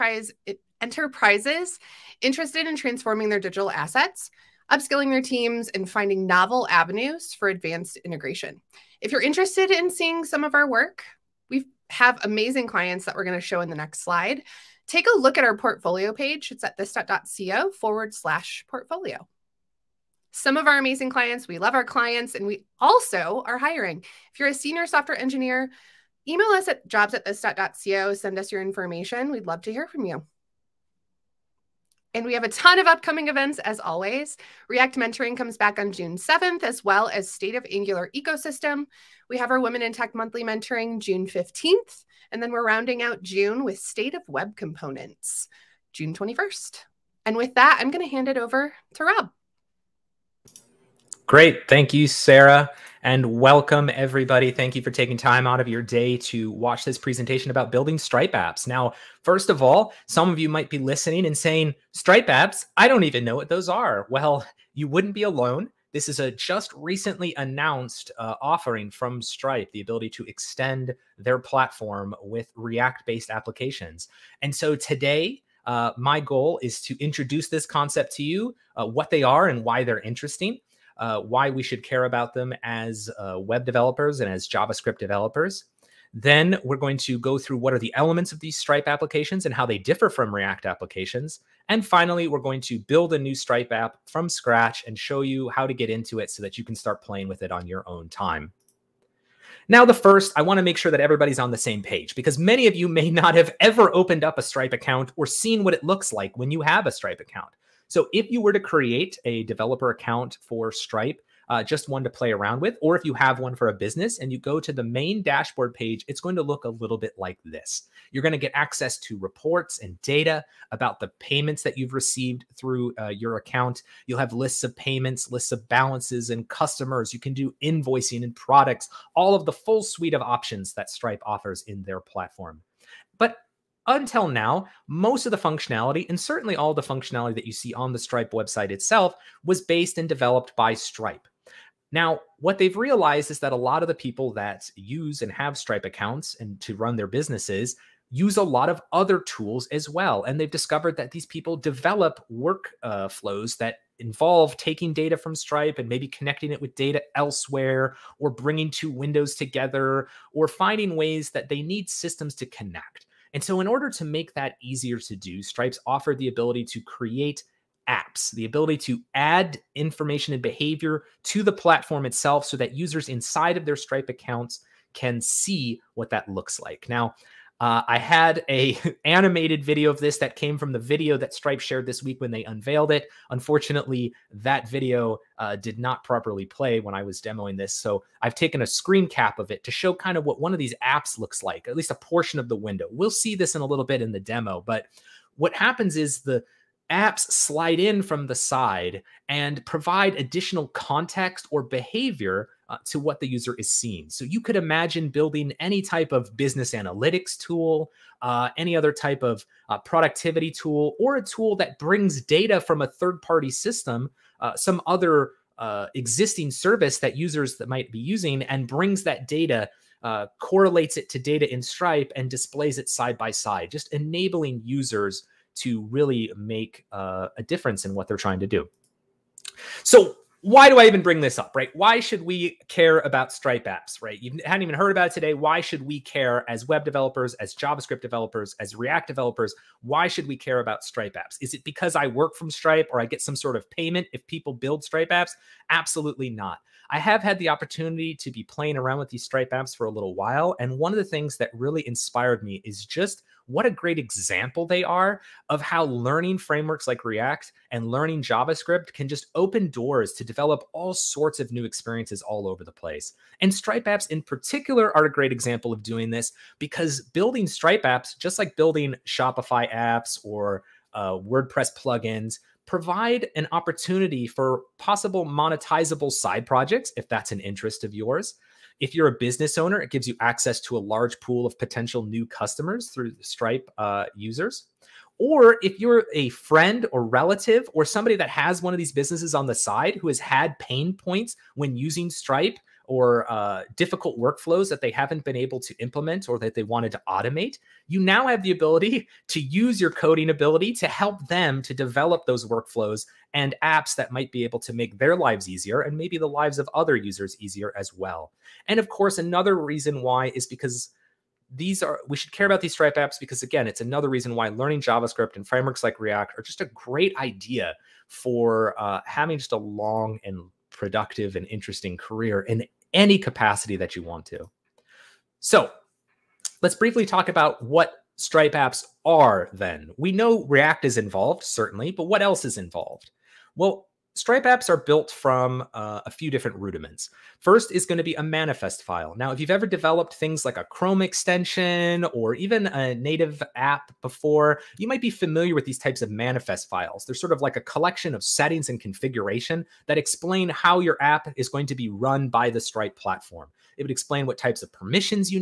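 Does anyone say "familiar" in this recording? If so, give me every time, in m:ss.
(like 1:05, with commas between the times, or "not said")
5:45.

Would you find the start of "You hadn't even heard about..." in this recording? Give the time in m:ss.
3:54.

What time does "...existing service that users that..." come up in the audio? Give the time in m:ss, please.
3:35.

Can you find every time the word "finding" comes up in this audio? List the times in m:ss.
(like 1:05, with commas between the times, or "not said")
0:05, 2:40.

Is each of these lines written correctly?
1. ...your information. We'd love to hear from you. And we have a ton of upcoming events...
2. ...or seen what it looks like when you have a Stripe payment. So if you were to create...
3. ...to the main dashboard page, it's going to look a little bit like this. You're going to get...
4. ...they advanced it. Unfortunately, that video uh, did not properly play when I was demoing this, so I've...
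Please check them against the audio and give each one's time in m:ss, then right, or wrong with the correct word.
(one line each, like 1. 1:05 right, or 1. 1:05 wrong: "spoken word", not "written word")
1. 0:28 right
2. 1:45 wrong: "account", not "payment"
3. 1:54 right
4. 3:02 wrong: "unveiled", not "advanced".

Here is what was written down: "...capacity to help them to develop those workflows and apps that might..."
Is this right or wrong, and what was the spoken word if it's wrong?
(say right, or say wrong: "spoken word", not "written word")
wrong: "ability", not "capacity".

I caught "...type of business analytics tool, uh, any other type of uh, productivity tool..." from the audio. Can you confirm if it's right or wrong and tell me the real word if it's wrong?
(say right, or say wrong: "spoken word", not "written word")
right.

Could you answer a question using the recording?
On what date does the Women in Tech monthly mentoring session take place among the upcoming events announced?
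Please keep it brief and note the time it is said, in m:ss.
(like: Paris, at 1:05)
June 15th, at 0:40.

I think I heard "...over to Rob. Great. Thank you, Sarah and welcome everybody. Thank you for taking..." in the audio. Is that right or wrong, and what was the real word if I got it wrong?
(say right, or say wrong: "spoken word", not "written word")
right.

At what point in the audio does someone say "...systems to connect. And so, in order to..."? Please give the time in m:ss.
2:41.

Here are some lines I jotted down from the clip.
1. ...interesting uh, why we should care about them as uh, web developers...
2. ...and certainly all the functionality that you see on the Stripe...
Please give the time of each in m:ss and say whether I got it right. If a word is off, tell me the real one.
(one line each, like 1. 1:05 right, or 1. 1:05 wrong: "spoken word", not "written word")
1. 1:19 right
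2. 2:16 right.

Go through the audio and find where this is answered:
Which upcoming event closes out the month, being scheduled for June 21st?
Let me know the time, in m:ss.
0:43.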